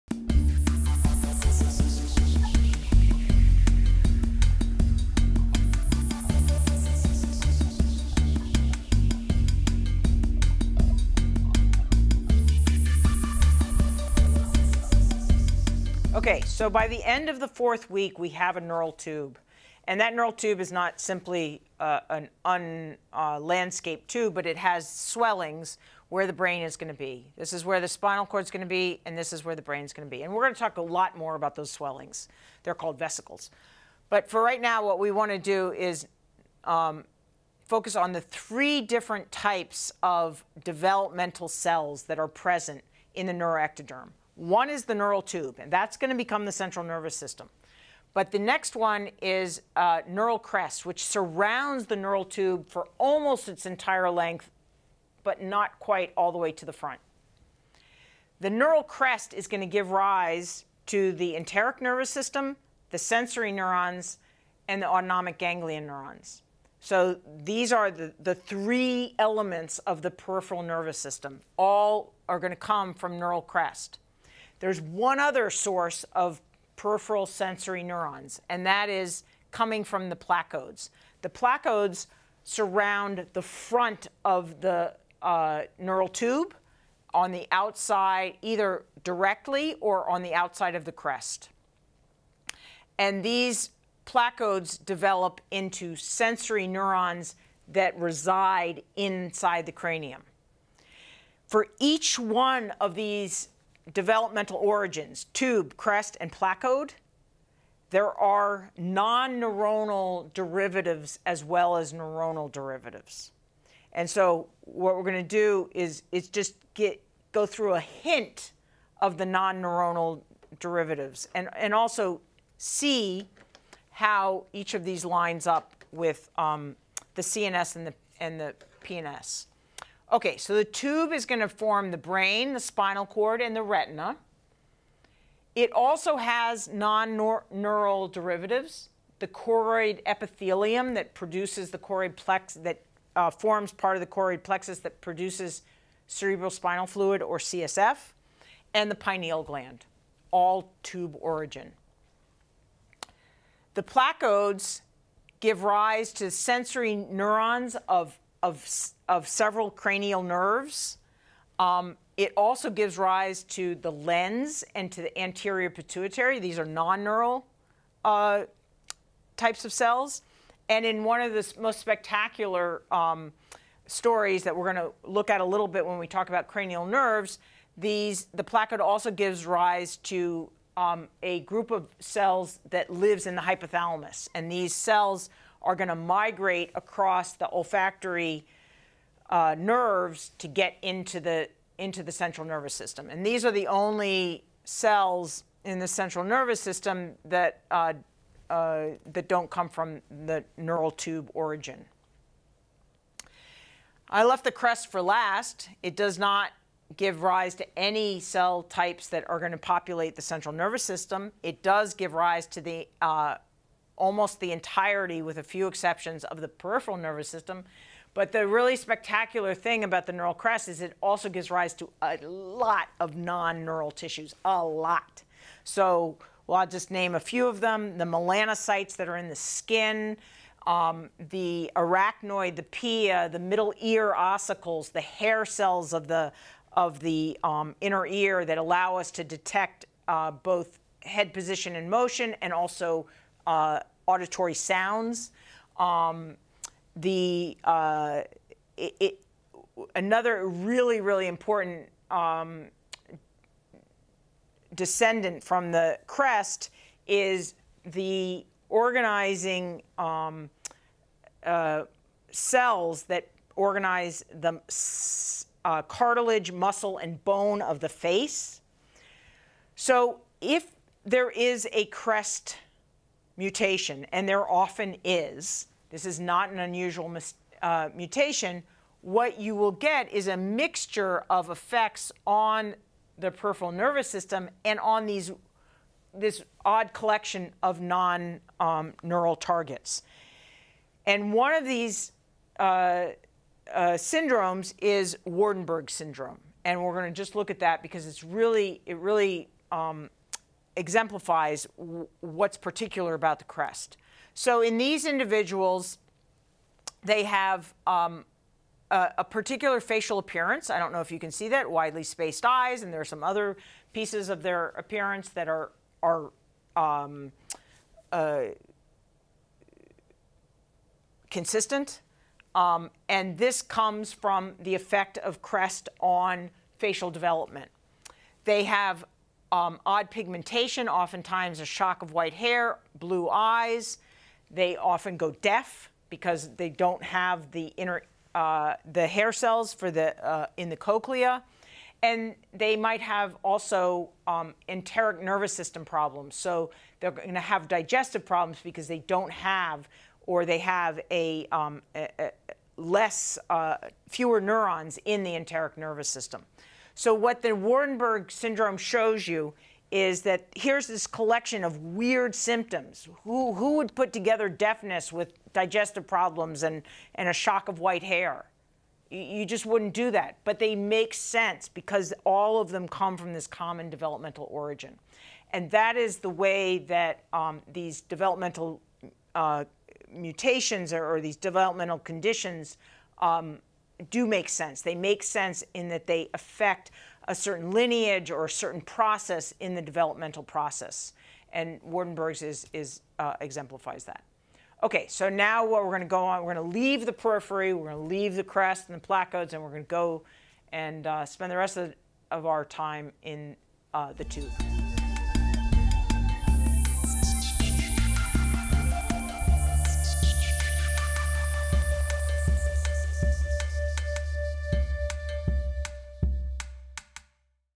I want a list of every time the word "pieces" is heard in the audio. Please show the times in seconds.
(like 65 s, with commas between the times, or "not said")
313 s.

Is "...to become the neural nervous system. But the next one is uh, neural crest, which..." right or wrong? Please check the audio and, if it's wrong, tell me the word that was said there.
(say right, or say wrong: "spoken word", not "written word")
wrong: "central", not "neural".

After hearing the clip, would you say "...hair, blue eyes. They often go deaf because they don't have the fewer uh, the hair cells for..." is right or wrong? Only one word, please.
wrong.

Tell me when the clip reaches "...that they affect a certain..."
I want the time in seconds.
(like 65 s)
385 s.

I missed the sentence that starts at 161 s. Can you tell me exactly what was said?
Um, it also gives rise to the lens and to the anterior pituitary.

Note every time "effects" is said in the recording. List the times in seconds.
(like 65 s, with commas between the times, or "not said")
281 s, 324 s.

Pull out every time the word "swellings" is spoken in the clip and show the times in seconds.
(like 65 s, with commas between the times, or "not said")
24 s, 31 s.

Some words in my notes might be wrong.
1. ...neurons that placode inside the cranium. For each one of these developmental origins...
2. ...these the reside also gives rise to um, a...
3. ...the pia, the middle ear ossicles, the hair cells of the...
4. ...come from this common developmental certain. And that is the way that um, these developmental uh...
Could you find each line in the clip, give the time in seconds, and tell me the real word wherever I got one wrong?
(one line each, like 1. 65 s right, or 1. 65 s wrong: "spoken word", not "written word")
1. 96 s wrong: "reside", not "placode"
2. 177 s wrong: "placode", not "reside"
3. 232 s right
4. 372 s wrong: "origin", not "certain".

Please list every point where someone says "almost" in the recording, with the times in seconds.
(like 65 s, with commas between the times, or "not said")
52 s, 214 s.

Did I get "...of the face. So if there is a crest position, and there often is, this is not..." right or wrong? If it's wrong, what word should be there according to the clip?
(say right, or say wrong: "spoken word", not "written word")
wrong: "mutation", not "position".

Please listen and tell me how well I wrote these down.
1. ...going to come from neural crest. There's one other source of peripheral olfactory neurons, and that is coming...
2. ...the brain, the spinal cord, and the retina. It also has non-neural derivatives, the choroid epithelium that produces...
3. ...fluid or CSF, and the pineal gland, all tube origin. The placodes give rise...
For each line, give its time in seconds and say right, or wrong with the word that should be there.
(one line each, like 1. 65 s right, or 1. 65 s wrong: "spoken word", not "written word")
1. 72 s wrong: "sensory", not "olfactory"
2. 131 s right
3. 146 s right.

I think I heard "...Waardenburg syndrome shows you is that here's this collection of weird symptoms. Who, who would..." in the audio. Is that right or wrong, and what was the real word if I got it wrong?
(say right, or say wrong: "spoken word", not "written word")
right.